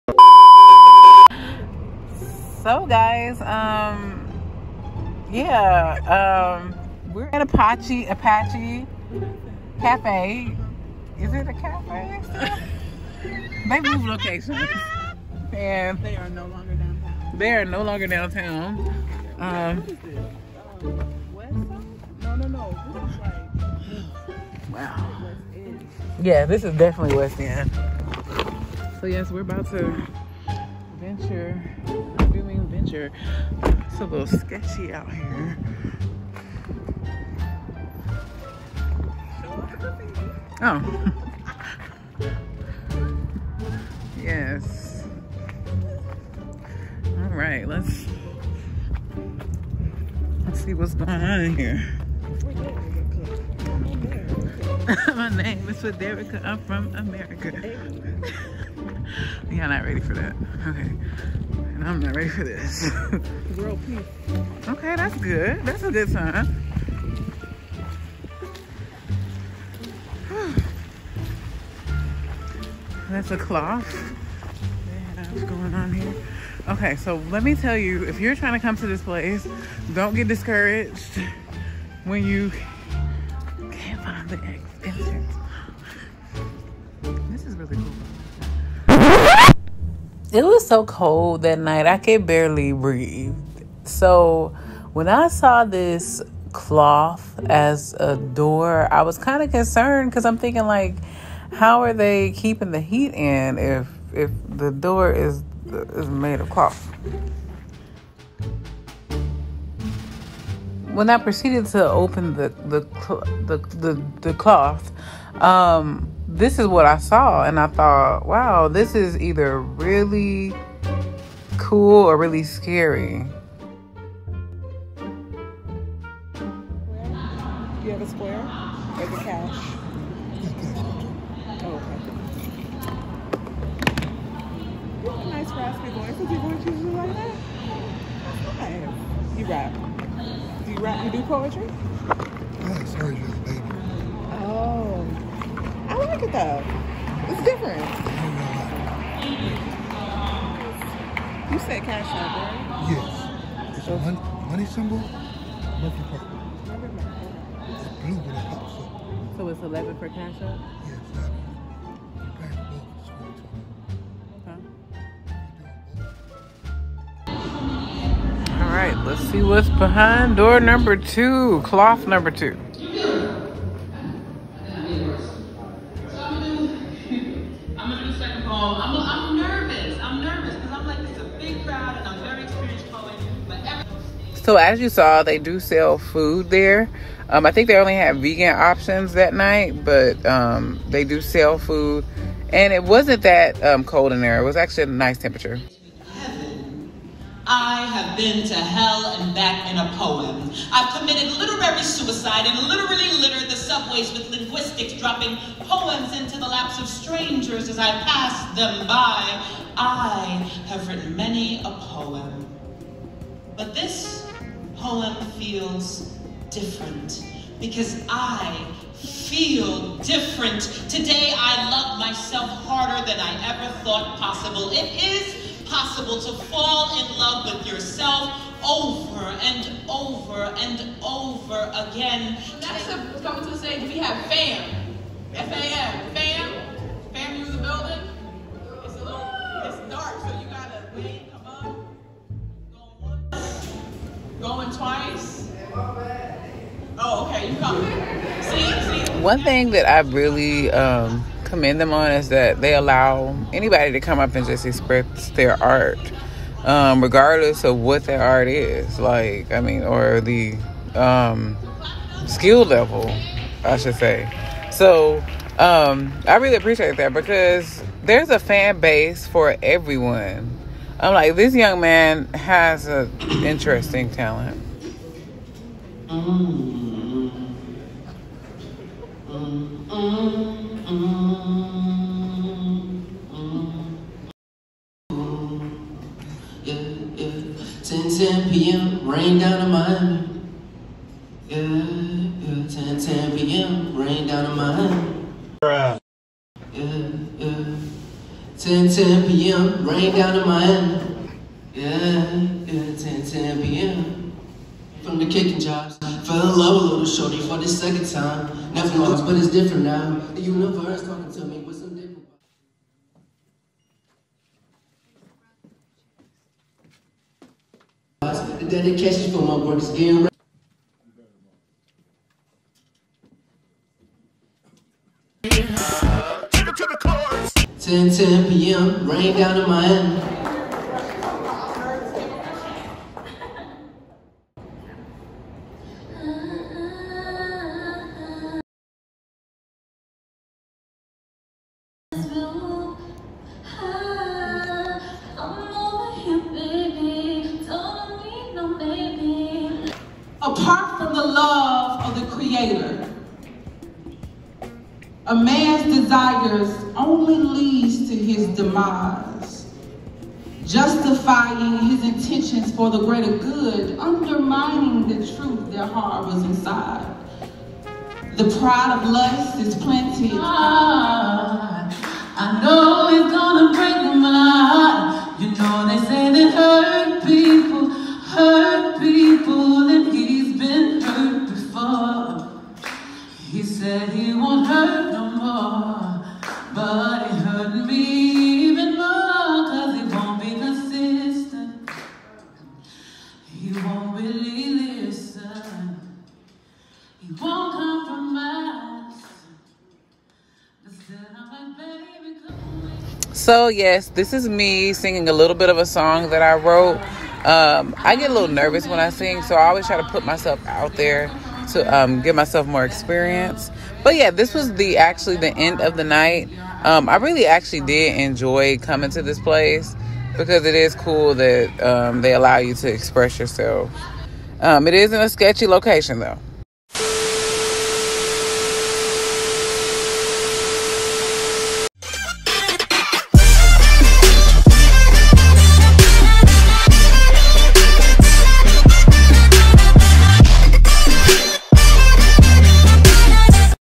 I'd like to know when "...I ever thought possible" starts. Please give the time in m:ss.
3:43.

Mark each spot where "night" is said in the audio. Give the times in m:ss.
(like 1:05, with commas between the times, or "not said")
1:31, 3:09, 6:56.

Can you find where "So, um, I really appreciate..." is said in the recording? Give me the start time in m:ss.
4:24.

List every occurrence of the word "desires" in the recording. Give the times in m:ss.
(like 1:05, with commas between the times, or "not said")
5:55.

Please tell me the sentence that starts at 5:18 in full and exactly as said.
dedication for my work is getting ready.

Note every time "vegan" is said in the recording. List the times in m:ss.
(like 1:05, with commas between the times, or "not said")
3:08.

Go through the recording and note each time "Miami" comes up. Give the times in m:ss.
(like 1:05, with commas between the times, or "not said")
4:49, 4:54, 5:00, 5:29.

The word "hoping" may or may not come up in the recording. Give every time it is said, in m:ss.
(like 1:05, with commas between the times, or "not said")
not said.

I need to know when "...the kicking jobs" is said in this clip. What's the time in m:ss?
5:05.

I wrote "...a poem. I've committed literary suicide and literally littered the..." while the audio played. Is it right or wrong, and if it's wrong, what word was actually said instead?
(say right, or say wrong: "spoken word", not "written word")
right.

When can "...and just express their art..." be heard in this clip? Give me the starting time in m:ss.
4:14.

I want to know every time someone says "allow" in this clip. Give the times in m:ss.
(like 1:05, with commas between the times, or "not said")
4:12, 7:02.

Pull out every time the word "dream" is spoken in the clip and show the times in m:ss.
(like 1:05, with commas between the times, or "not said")
not said.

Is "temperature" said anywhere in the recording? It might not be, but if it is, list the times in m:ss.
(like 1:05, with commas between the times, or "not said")
3:15.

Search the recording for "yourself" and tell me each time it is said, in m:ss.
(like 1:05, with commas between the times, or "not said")
3:47, 7:03.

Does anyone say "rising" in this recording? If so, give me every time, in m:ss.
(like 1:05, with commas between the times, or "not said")
not said.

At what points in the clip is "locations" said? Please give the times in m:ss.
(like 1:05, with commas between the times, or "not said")
0:14, 7:05.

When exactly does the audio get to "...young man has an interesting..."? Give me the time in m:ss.
4:31.